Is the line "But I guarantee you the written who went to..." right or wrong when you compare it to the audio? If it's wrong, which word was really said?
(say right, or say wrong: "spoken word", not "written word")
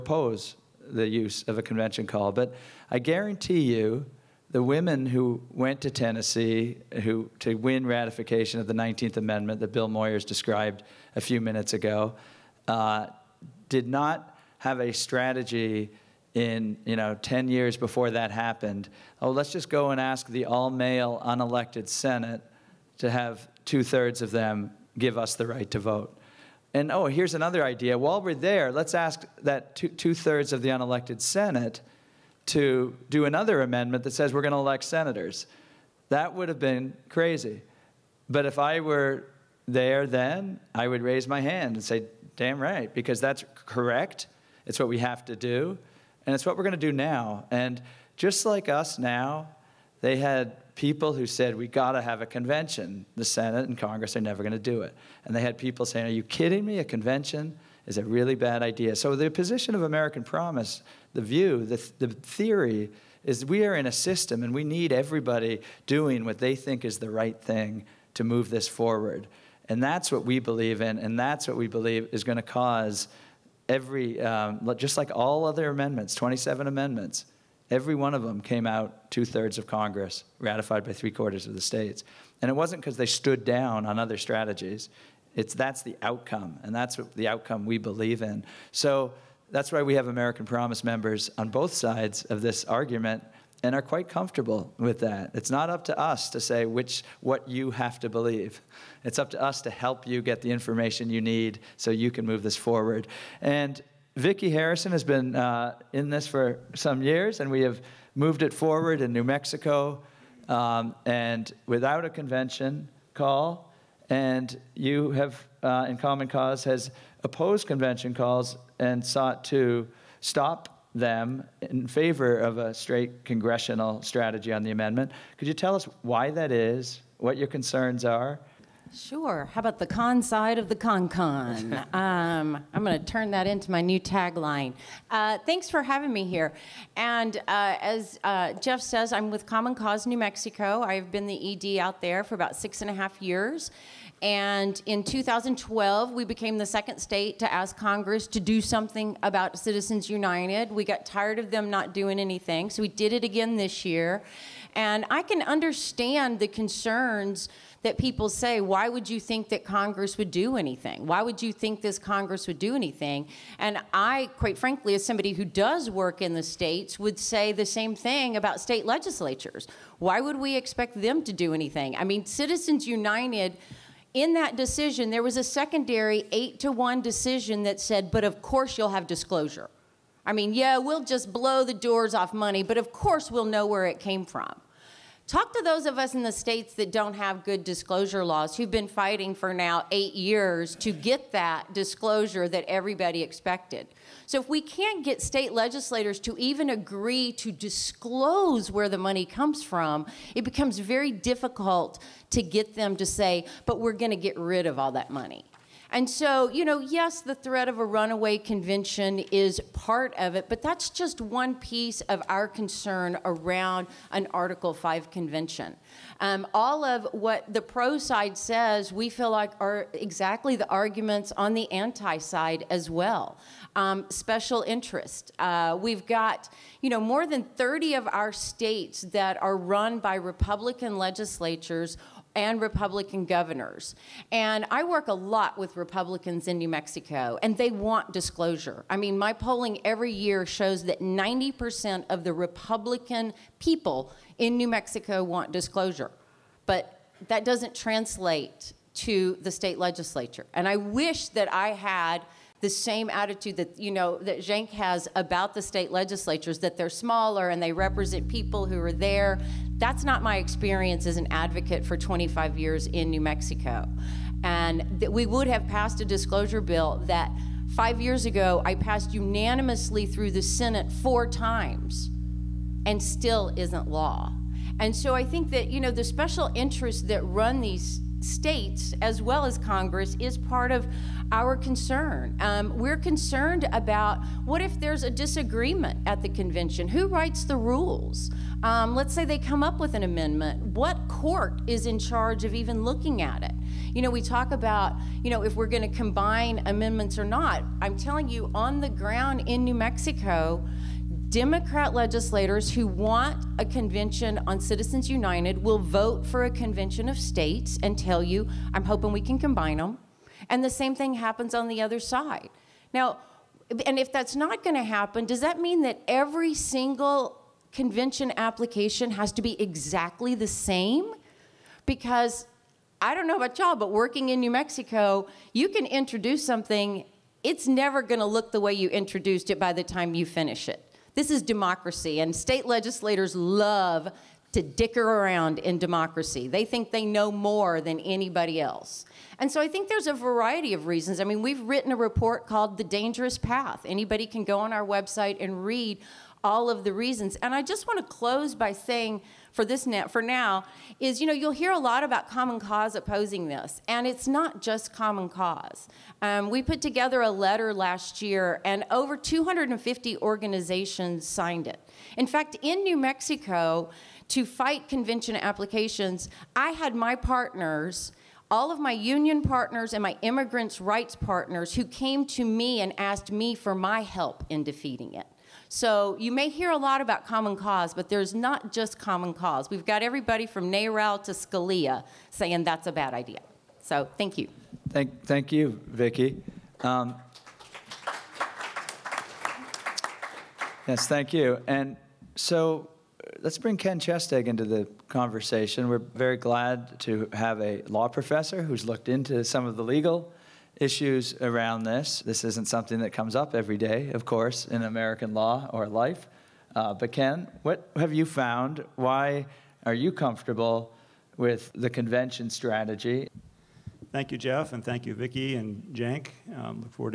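wrong: "women", not "written".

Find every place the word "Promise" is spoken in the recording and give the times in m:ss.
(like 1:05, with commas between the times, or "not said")
1:00, 1:30.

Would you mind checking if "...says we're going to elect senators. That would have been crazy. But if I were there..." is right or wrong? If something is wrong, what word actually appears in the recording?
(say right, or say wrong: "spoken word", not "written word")
right.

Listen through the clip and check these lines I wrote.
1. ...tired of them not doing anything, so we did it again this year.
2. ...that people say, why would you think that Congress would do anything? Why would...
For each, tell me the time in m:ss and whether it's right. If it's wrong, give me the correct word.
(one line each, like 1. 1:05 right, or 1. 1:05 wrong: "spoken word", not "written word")
1. 2:31 right
2. 2:37 right.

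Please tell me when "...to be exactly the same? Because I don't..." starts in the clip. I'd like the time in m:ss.
5:19.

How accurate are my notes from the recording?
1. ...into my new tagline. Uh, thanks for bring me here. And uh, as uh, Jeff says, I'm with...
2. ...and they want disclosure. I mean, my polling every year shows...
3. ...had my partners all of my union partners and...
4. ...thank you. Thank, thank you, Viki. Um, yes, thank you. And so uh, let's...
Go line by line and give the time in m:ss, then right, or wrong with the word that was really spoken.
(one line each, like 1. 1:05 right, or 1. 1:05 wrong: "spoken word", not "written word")
1. 2:13 wrong: "having", not "bring"
2. 3:57 right
3. 6:06 right
4. 6:24 right.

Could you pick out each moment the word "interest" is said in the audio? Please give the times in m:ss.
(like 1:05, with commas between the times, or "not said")
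3:44, 4:36.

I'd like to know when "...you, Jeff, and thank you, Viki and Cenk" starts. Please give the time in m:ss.
6:54.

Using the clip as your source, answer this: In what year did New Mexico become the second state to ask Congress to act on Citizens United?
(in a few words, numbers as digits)
2012.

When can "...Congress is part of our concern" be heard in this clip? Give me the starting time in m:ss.
4:39.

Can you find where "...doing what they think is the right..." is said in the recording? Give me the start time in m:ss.
1:05.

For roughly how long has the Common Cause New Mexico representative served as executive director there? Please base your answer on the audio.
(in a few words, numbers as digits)
6 and a half years.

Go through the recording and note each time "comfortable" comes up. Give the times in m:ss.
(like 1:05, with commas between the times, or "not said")
1:34, 6:50.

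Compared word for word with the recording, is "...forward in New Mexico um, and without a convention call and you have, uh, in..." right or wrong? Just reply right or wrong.
right.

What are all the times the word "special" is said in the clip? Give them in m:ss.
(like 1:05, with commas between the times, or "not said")
3:44, 4:36.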